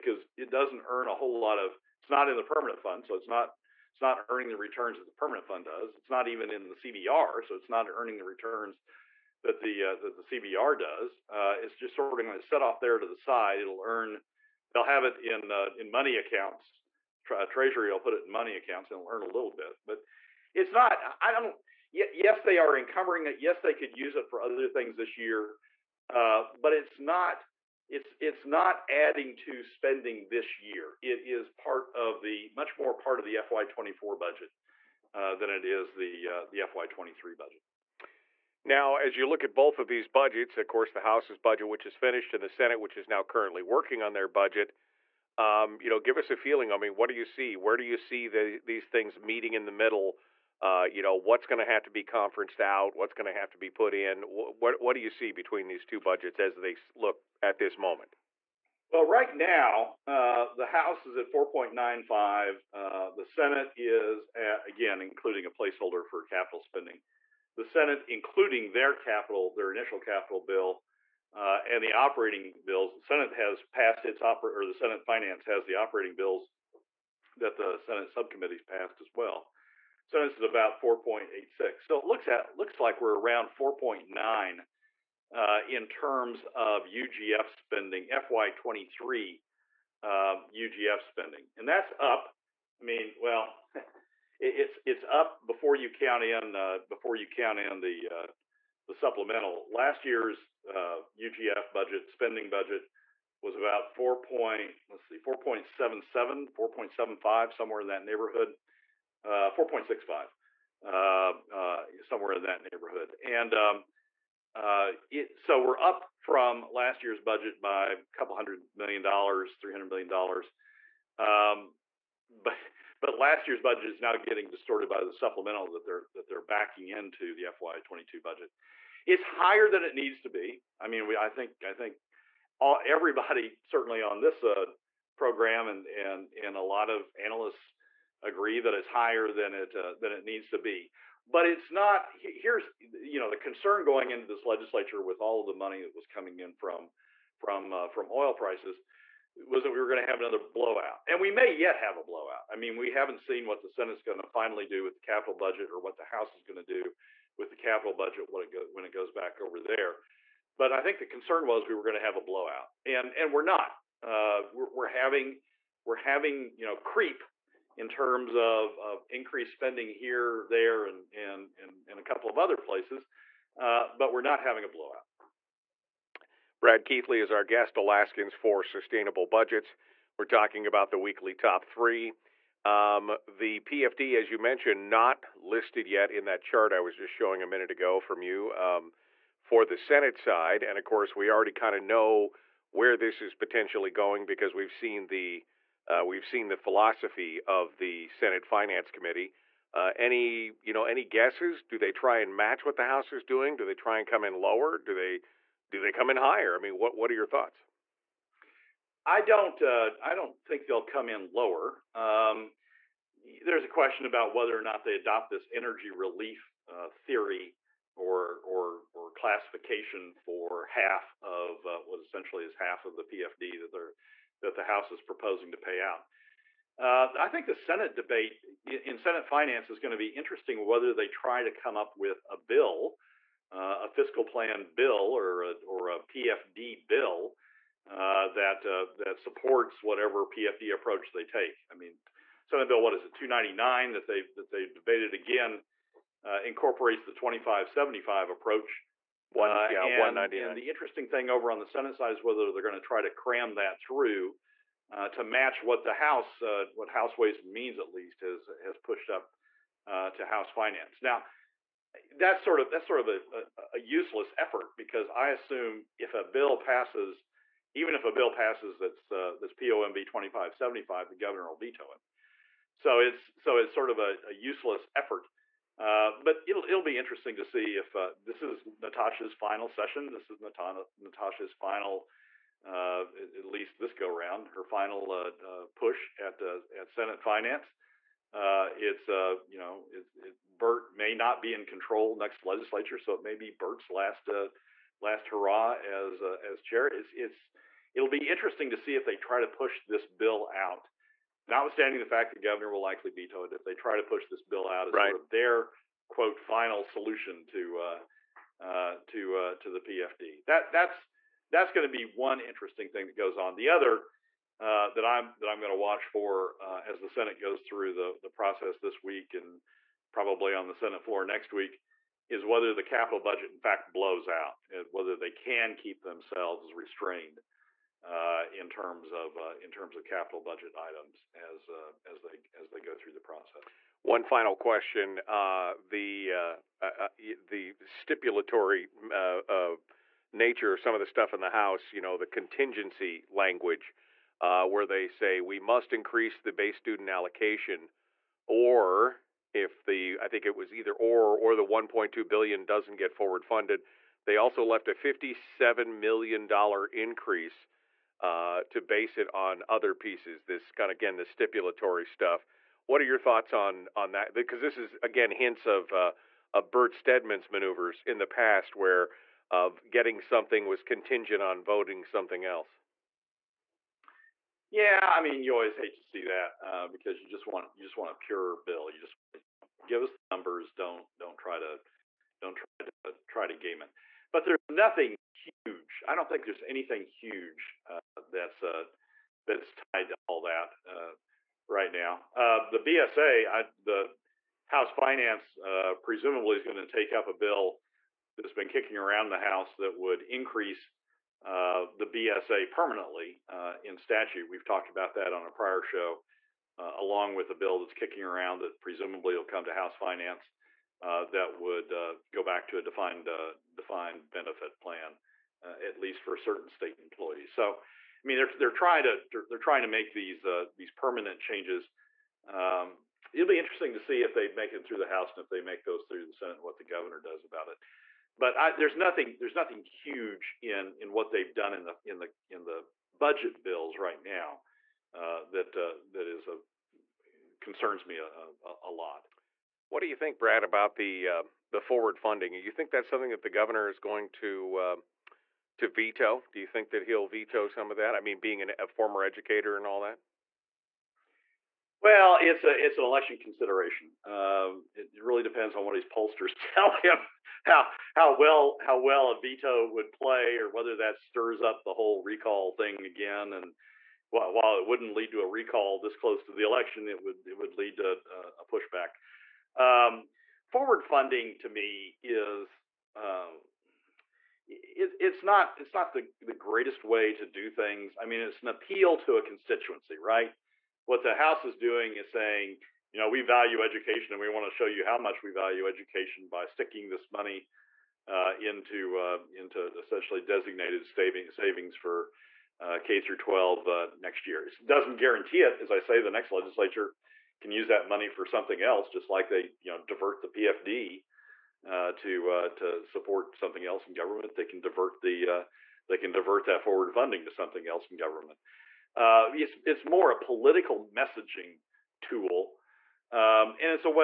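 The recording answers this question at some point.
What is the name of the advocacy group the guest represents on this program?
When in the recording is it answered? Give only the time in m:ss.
2:57.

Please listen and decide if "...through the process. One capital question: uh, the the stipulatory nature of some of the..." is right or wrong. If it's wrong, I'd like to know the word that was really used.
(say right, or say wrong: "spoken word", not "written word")
wrong: "final", not "capital".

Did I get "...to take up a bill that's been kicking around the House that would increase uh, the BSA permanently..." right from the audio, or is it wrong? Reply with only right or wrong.
right.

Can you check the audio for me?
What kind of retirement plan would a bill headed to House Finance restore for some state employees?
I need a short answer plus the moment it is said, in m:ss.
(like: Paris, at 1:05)
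defined benefit plan, at 6:53.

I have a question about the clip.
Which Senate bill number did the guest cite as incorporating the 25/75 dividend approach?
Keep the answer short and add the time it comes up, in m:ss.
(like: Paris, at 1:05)
199, at 4:09.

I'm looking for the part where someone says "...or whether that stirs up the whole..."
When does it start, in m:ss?
7:40.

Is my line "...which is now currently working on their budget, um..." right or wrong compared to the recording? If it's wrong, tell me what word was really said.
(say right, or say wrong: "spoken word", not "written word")
right.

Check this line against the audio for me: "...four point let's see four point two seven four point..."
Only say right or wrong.
wrong.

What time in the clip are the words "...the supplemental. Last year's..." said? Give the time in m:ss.
1:38.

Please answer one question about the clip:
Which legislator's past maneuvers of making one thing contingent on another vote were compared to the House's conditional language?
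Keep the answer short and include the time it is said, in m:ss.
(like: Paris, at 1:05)
Bert Stedman, at 6:06.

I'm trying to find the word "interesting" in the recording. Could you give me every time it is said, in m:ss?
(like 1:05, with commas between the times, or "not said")
3:50, 4:10, 4:36, 4:58, 5:12, 7:03.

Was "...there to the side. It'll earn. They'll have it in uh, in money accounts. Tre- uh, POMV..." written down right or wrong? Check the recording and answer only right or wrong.
wrong.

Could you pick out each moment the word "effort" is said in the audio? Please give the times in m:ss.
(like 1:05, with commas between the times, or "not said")
4:24, 4:34.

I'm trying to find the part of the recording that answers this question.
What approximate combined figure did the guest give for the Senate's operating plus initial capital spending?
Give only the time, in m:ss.
1:20.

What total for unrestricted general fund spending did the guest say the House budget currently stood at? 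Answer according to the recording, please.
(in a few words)
4.95.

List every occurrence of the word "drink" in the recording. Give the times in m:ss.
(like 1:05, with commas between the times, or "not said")
not said.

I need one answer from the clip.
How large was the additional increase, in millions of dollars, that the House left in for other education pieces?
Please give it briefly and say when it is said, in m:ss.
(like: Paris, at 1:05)
57 million, at 5:54.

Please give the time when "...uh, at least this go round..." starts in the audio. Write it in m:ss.
4:42.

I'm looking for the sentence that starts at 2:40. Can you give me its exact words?
But I think the concern was we were going to have a blowout, and and we're not.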